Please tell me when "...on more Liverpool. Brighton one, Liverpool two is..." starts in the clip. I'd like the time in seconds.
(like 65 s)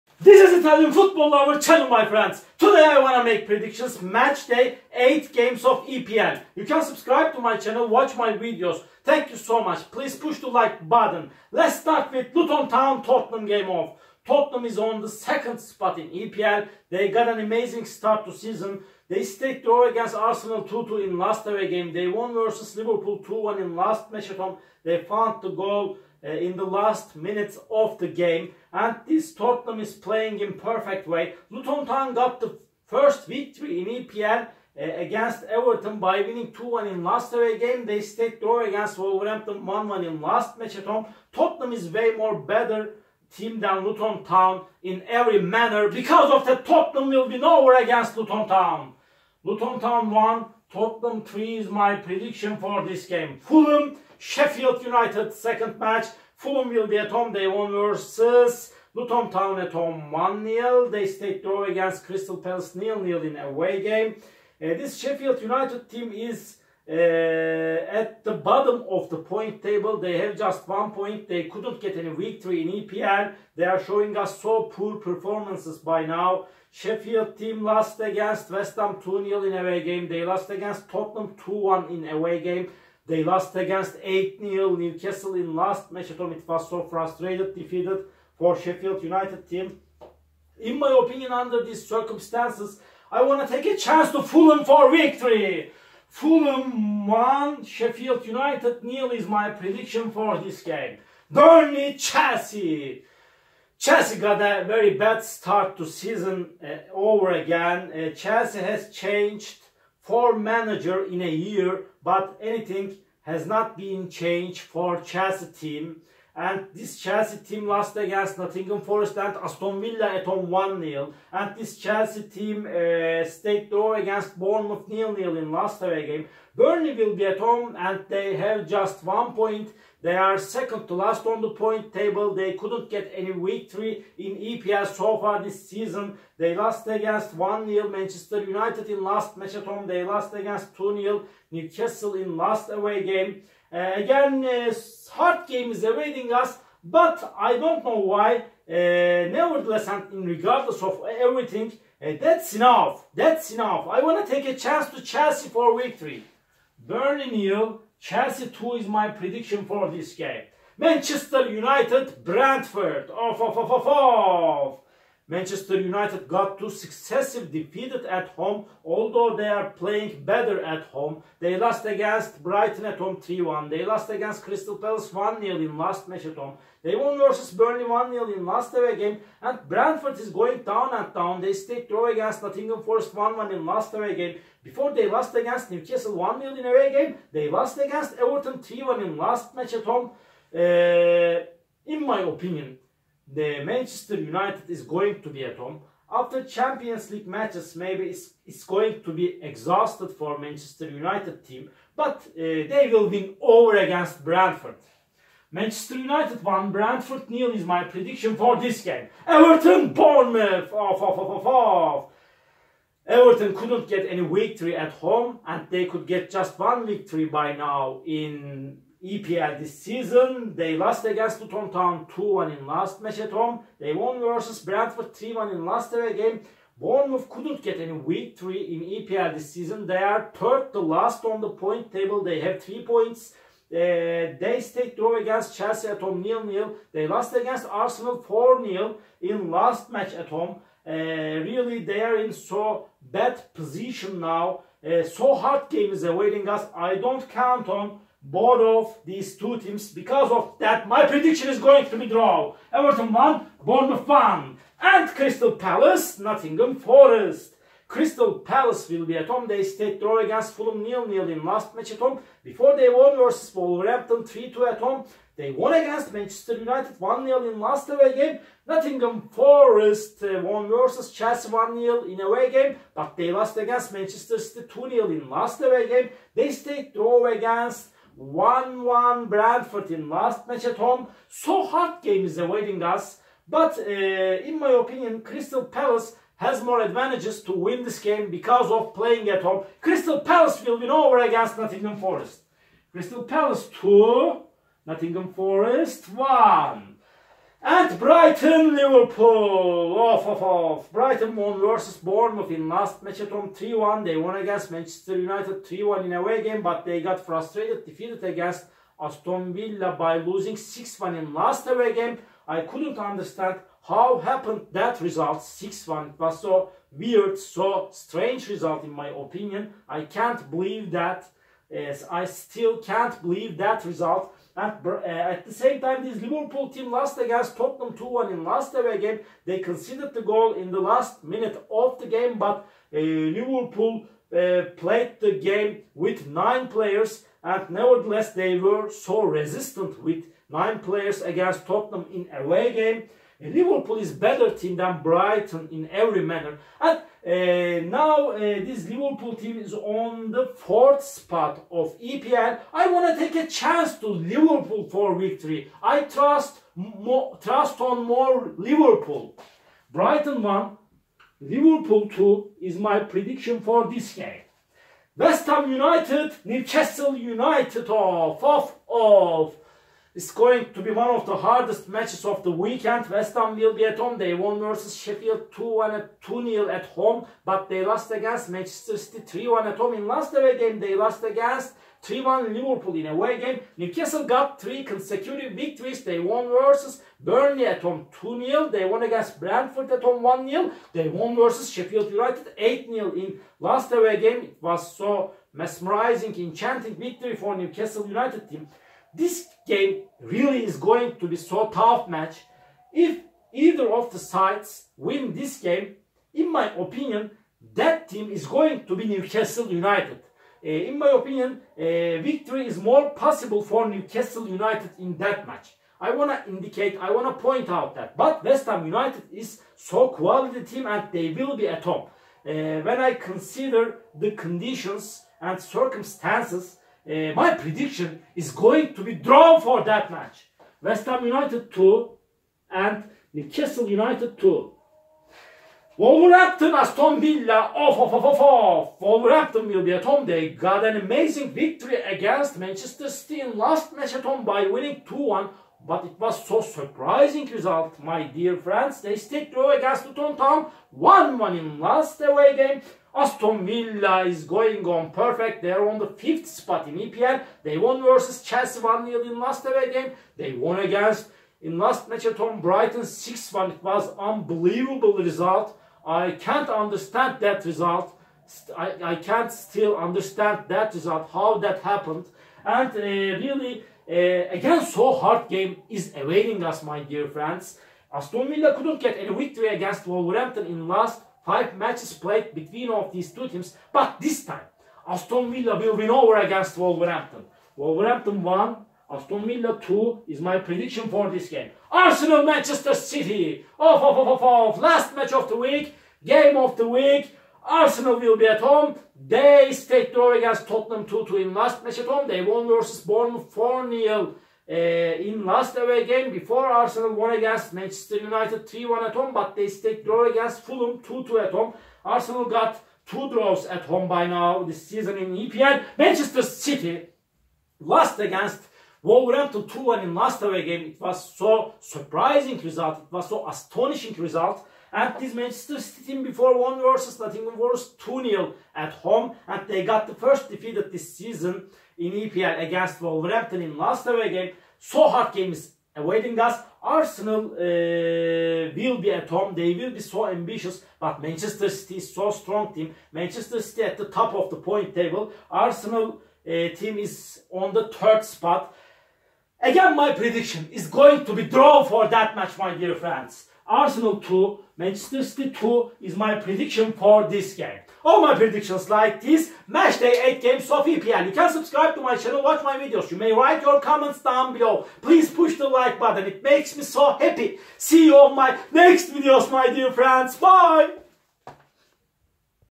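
357 s.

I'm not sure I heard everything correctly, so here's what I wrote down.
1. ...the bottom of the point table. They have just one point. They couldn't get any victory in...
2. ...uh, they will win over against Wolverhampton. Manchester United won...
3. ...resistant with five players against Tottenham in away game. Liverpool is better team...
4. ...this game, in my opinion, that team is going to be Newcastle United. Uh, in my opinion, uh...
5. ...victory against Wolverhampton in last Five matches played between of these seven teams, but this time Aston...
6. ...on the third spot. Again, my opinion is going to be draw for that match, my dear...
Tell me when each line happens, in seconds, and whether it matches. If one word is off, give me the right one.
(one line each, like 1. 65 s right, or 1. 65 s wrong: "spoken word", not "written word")
1. 68 s right
2. 202 s wrong: "Bradford", not "Wolverhampton"
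3. 339 s wrong: "nine", not "five"
4. 405 s right
5. 479 s wrong: "two", not "seven"
6. 547 s wrong: "prediction", not "opinion".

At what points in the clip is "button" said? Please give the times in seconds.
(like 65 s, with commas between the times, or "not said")
10 s, 565 s.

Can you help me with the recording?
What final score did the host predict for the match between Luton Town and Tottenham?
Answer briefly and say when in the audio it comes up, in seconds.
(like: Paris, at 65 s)
Luton Town 1, Tottenham 3, at 49 s.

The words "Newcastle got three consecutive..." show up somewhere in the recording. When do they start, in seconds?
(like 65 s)
383 s.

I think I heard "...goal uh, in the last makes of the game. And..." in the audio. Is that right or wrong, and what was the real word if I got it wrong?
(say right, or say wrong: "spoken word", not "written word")
wrong: "minutes", not "makes".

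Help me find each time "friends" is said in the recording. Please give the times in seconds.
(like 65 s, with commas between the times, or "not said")
2 s, 448 s, 477 s, 552 s, 569 s.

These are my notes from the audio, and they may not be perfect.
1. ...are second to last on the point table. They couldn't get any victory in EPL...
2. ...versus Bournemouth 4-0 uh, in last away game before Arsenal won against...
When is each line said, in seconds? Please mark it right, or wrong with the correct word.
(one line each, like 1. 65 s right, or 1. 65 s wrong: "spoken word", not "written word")
1. 130 s right
2. 502 s right.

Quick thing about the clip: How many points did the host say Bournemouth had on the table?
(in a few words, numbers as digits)
3.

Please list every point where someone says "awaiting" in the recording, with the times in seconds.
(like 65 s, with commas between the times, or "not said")
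145 s, 246 s, 282 s, 476 s, 535 s.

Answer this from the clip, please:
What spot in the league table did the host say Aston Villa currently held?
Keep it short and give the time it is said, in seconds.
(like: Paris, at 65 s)
5th, at 456 s.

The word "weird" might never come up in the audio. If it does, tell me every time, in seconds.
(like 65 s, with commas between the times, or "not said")
316 s.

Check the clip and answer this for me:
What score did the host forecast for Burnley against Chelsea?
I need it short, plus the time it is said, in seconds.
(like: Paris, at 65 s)
Burnley 0, Chelsea 2, at 156 s.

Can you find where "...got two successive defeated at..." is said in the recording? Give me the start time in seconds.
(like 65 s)
166 s.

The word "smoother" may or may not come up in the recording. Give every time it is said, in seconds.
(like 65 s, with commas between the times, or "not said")
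not said.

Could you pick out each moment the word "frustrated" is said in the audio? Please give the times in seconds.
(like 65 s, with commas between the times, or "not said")
86 s, 307 s.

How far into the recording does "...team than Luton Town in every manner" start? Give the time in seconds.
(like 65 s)
43 s.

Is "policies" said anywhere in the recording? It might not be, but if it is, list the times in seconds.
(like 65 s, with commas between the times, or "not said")
not said.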